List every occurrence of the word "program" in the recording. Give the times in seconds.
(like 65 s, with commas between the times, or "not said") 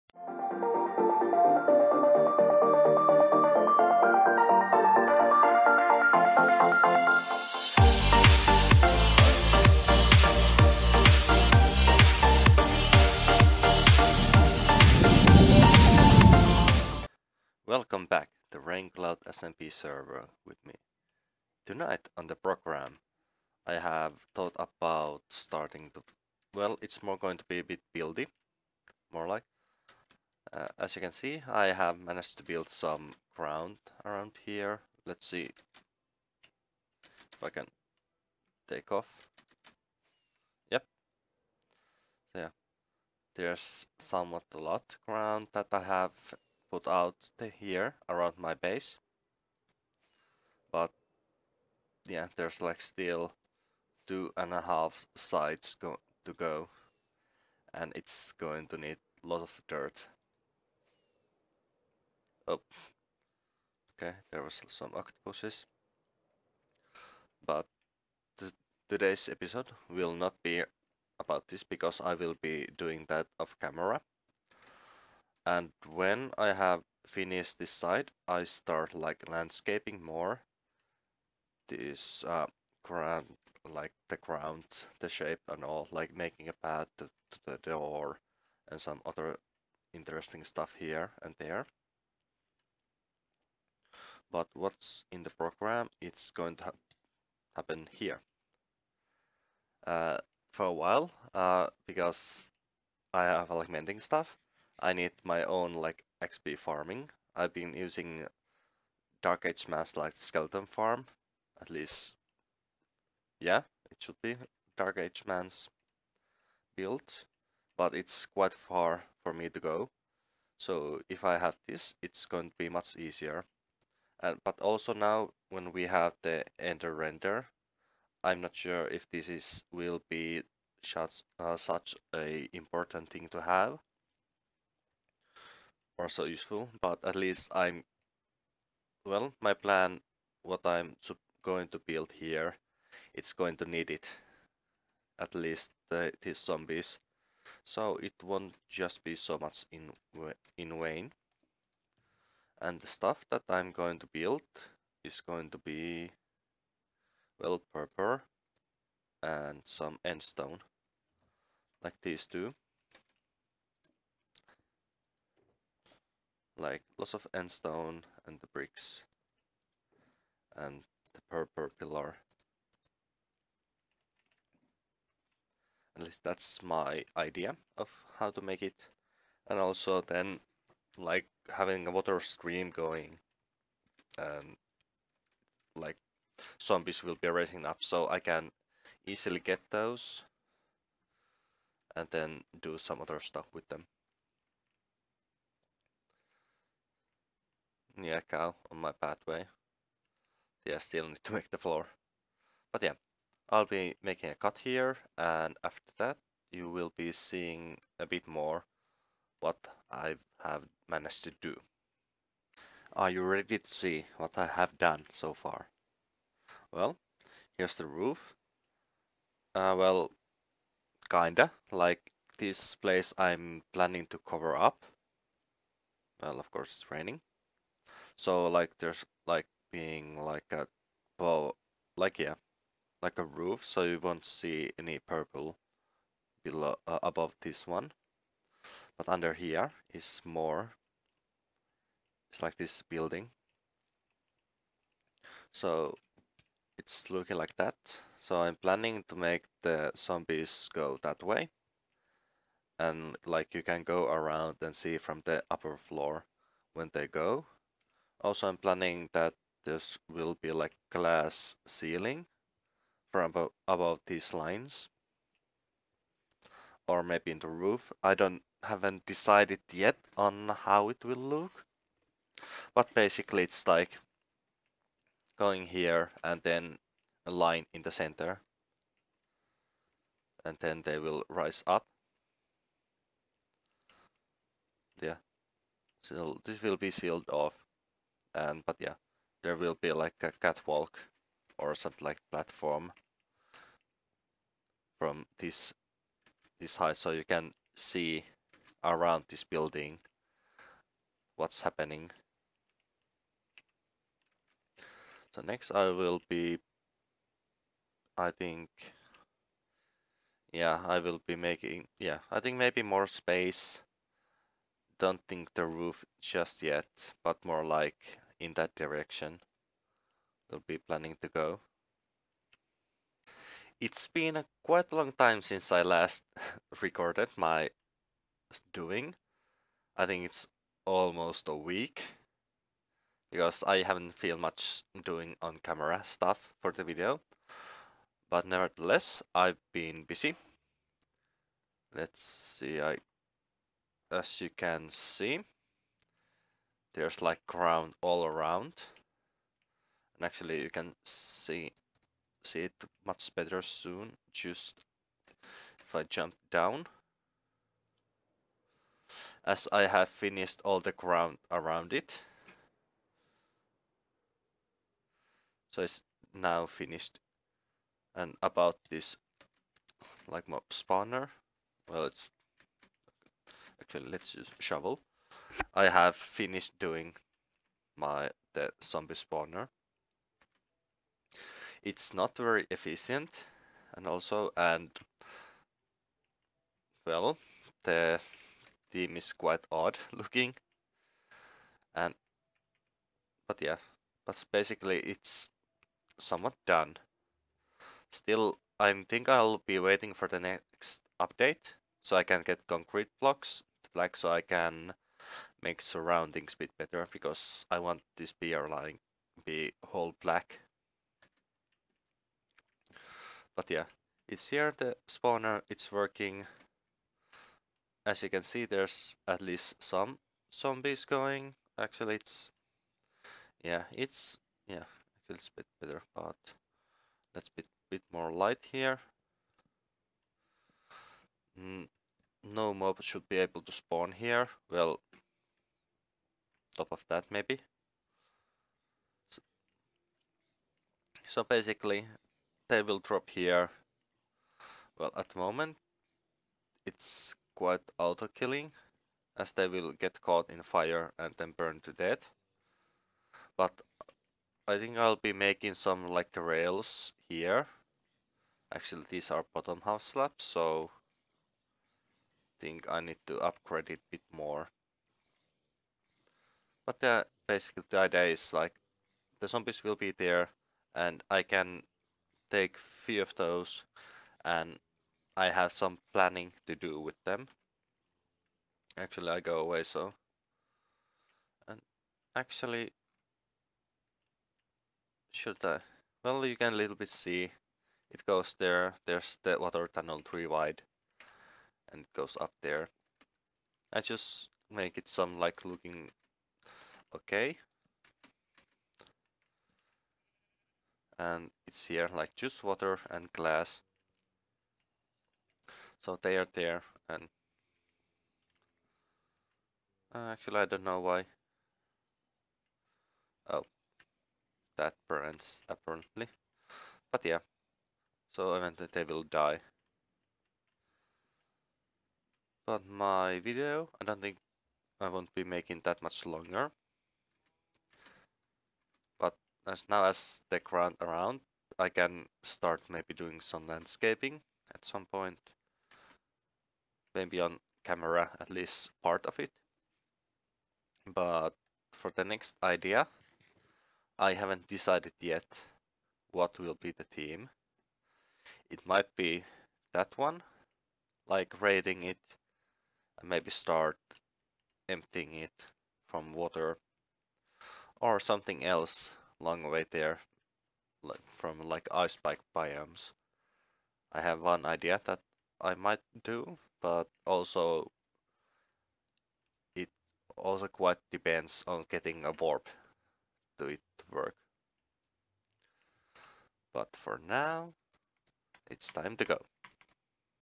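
22 s, 95 s.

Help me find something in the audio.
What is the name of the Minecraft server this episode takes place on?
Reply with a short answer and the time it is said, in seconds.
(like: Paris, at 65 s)
Raincloud SMP, at 18 s.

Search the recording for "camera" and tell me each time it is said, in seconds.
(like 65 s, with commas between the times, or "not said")
73 s, 335 s, 537 s.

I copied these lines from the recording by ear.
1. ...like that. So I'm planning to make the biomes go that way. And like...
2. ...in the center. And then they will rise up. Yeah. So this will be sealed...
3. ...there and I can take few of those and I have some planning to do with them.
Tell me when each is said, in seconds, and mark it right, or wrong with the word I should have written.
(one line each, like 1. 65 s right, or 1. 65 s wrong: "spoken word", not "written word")
1. 247 s wrong: "zombies", not "biomes"
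2. 277 s right
3. 470 s right.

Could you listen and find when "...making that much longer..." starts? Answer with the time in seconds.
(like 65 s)
525 s.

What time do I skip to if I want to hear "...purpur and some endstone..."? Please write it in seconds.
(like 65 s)
157 s.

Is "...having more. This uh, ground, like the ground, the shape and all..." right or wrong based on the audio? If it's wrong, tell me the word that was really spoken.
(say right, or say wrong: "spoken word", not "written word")
wrong: "landscaping", not "having".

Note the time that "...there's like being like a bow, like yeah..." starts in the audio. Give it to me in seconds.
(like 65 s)
228 s.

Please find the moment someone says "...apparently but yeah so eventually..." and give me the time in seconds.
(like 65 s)
515 s.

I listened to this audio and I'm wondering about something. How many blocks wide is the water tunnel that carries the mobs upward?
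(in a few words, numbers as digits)
3.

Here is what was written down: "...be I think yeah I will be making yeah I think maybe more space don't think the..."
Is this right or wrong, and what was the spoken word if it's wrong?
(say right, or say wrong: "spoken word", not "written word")
right.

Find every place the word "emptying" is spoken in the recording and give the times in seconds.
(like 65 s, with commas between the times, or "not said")
554 s.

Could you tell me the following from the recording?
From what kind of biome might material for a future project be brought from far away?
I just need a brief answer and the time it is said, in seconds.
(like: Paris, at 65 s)
ice spike biomes, at 561 s.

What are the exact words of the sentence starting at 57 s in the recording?
And it's going to need a lot of dirt.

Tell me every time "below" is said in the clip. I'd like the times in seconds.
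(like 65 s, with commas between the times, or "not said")
236 s.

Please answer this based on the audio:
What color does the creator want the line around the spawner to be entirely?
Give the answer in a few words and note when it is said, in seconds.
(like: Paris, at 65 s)
black, at 410 s.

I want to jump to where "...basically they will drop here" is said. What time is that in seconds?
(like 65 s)
441 s.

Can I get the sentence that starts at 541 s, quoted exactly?
But for the next idea, I haven't decided yet what will be the theme.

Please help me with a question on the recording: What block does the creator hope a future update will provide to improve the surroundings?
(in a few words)
concrete.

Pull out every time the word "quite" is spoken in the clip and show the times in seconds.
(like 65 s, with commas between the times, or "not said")
118 s, 324 s, 389 s, 447 s, 570 s.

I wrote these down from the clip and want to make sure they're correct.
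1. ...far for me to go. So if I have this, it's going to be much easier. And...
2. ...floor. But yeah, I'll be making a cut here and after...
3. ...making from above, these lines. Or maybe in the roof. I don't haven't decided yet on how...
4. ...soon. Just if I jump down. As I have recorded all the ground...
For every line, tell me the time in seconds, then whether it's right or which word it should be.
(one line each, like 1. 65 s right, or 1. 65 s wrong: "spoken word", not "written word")
1. 118 s right
2. 201 s right
3. 261 s wrong: "ceiling", not "making"
4. 353 s wrong: "finished", not "recorded".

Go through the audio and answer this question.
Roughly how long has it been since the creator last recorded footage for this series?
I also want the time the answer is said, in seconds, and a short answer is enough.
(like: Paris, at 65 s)
almost a week, at 330 s.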